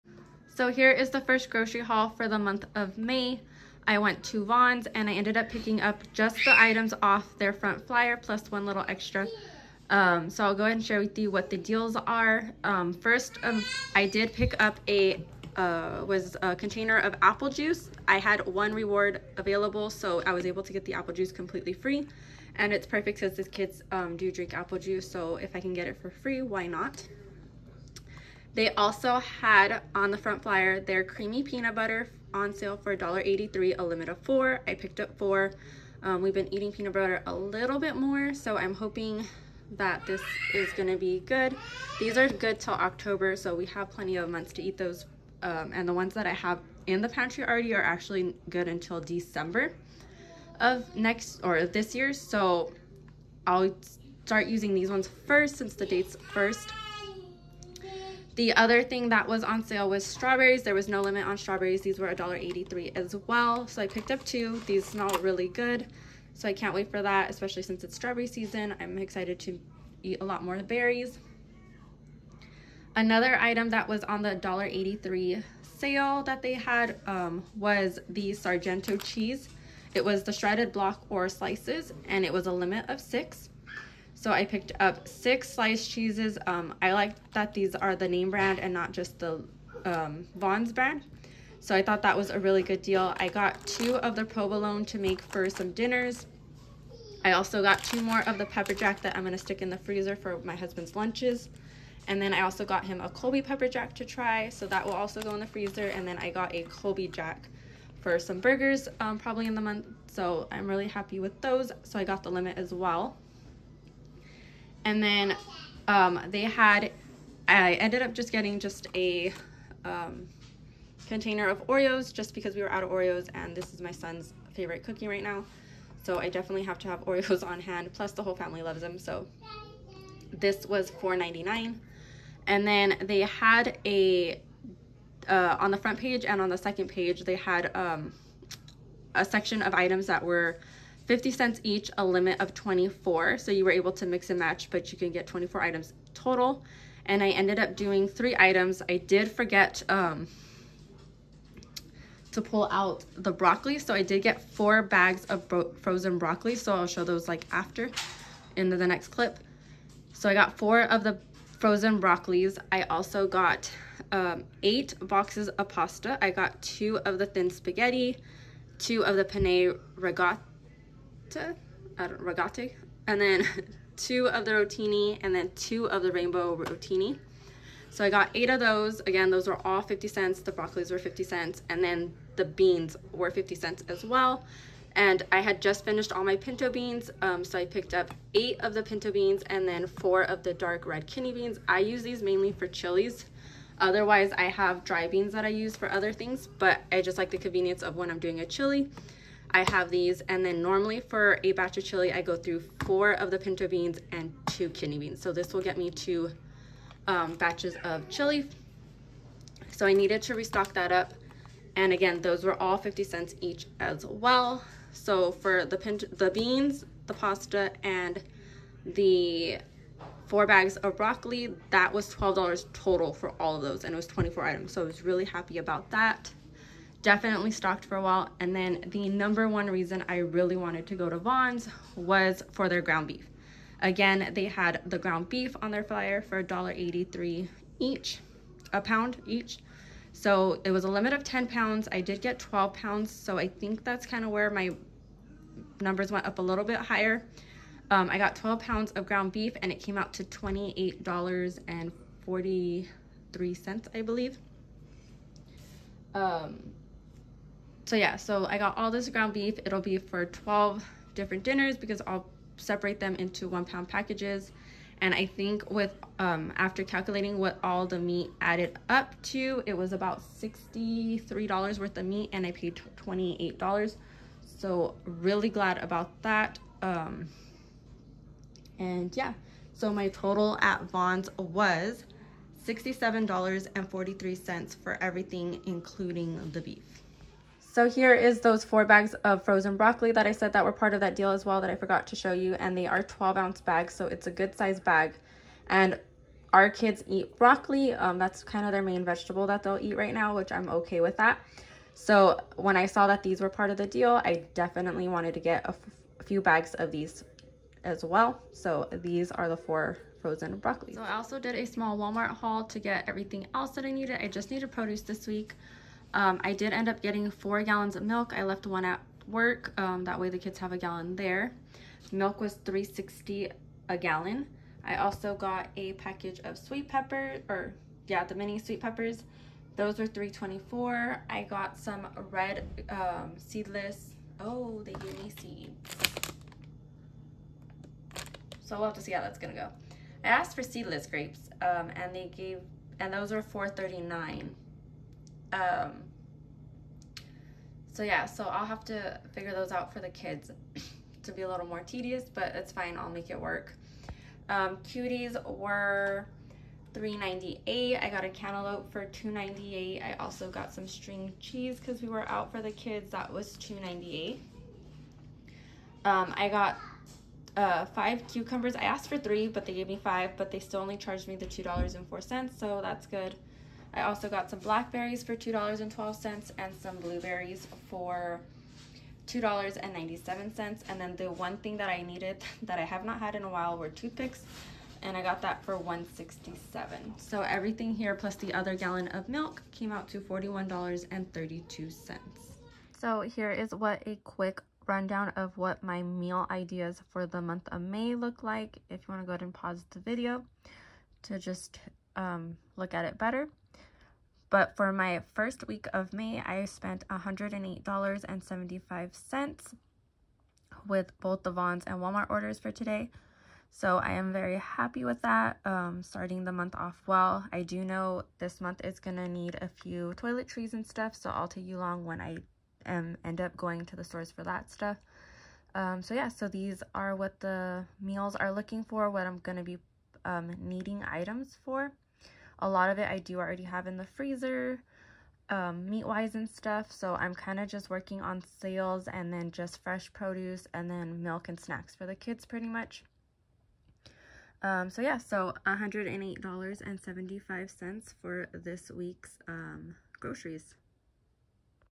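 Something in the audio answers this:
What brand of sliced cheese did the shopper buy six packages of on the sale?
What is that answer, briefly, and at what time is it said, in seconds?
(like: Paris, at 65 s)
Sargento, at 78 s.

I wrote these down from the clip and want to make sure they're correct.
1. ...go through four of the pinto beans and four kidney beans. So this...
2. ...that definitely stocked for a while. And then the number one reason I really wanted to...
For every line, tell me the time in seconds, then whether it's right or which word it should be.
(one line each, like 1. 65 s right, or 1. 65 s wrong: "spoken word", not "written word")
1. 202 s wrong: "two", not "four"
2. 225 s right.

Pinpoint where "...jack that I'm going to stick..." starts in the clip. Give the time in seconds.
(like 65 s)
98 s.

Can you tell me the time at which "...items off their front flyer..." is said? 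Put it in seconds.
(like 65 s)
6 s.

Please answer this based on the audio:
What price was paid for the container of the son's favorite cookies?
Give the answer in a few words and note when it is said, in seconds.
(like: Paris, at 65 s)
$4.99, at 130 s.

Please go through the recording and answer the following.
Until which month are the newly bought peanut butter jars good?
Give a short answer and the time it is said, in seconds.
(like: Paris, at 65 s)
October, at 42 s.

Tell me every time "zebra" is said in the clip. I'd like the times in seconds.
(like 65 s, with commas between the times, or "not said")
not said.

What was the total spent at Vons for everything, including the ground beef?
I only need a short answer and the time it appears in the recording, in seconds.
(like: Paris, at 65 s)
$67.43, at 282 s.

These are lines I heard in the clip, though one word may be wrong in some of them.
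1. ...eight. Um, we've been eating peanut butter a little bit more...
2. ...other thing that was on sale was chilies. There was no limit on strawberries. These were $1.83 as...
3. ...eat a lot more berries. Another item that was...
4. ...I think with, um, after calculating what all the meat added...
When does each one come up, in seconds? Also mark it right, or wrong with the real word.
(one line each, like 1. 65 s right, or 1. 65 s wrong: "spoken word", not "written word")
1. 35 s wrong: "four", not "eight"
2. 58 s wrong: "strawberries", not "chilies"
3. 70 s right
4. 265 s right.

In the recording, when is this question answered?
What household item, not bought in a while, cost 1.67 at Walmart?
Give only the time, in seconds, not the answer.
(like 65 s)
383 s.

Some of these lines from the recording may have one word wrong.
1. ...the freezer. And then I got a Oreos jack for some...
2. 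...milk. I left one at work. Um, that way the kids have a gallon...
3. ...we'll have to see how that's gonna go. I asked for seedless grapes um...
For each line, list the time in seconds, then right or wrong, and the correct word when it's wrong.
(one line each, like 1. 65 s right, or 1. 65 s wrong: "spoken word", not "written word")
1. 105 s wrong: "Colby", not "Oreos"
2. 318 s right
3. 338 s right.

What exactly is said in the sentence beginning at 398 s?
If you want to go ahead and pause the video to just um, look at it better.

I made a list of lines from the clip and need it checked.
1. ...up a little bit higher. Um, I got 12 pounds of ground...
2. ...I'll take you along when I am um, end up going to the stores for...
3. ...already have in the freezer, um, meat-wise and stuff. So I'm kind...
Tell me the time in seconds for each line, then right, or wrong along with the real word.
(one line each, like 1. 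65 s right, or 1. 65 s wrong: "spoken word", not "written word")
1. 246 s right
2. 421 s right
3. 433 s right.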